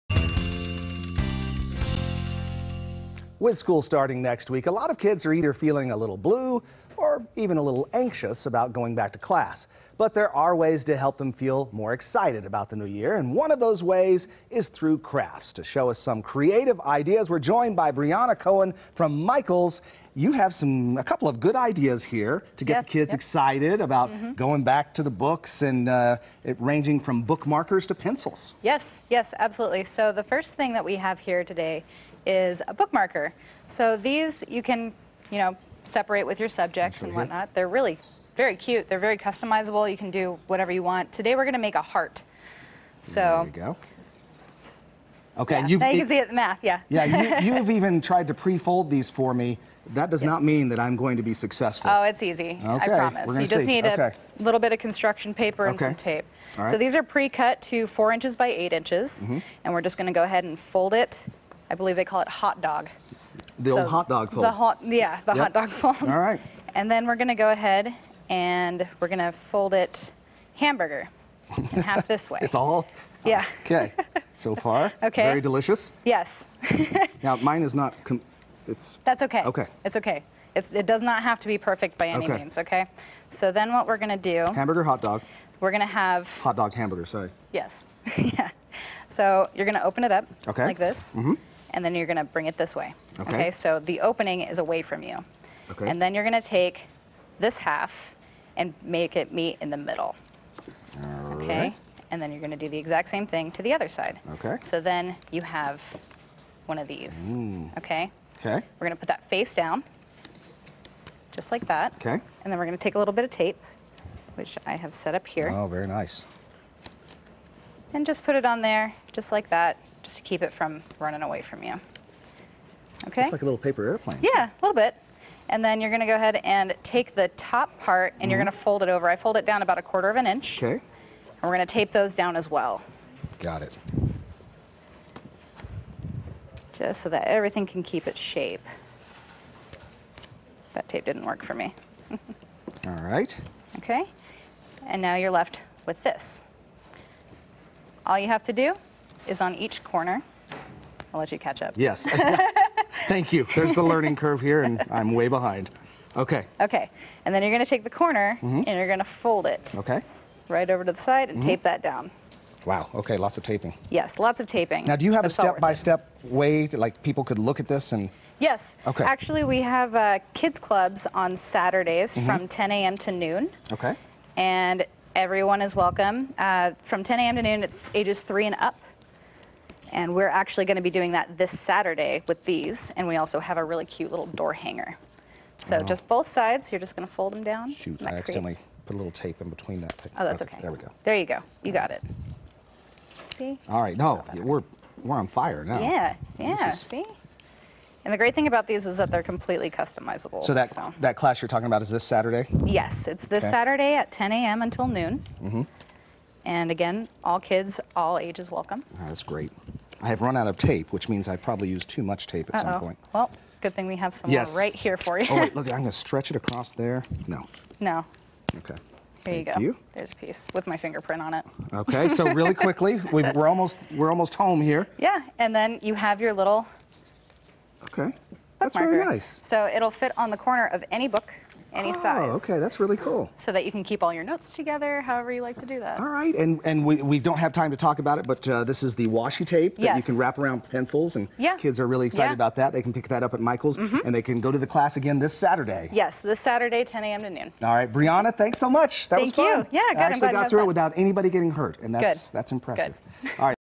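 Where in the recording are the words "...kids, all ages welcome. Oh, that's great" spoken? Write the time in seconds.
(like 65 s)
207 s.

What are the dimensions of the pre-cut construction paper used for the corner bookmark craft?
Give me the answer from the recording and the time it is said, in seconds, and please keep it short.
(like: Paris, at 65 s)
4 inches by 8 inches, at 57 s.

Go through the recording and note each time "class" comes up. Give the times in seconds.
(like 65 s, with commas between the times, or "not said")
9 s, 201 s, 244 s.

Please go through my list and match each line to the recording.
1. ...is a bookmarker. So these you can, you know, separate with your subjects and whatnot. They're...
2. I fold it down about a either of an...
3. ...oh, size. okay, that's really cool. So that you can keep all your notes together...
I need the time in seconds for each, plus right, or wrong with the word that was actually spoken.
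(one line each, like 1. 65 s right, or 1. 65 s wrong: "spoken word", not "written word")
1. 32 s right
2. 129 s wrong: "quarter", not "either"
3. 231 s right.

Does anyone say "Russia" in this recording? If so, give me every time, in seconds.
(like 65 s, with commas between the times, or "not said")
not said.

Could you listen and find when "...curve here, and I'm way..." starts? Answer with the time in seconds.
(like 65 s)
154 s.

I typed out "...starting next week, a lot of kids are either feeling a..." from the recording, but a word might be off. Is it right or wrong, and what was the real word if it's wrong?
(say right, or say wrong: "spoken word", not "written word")
right.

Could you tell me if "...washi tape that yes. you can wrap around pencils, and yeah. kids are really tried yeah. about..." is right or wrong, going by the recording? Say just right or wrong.
wrong.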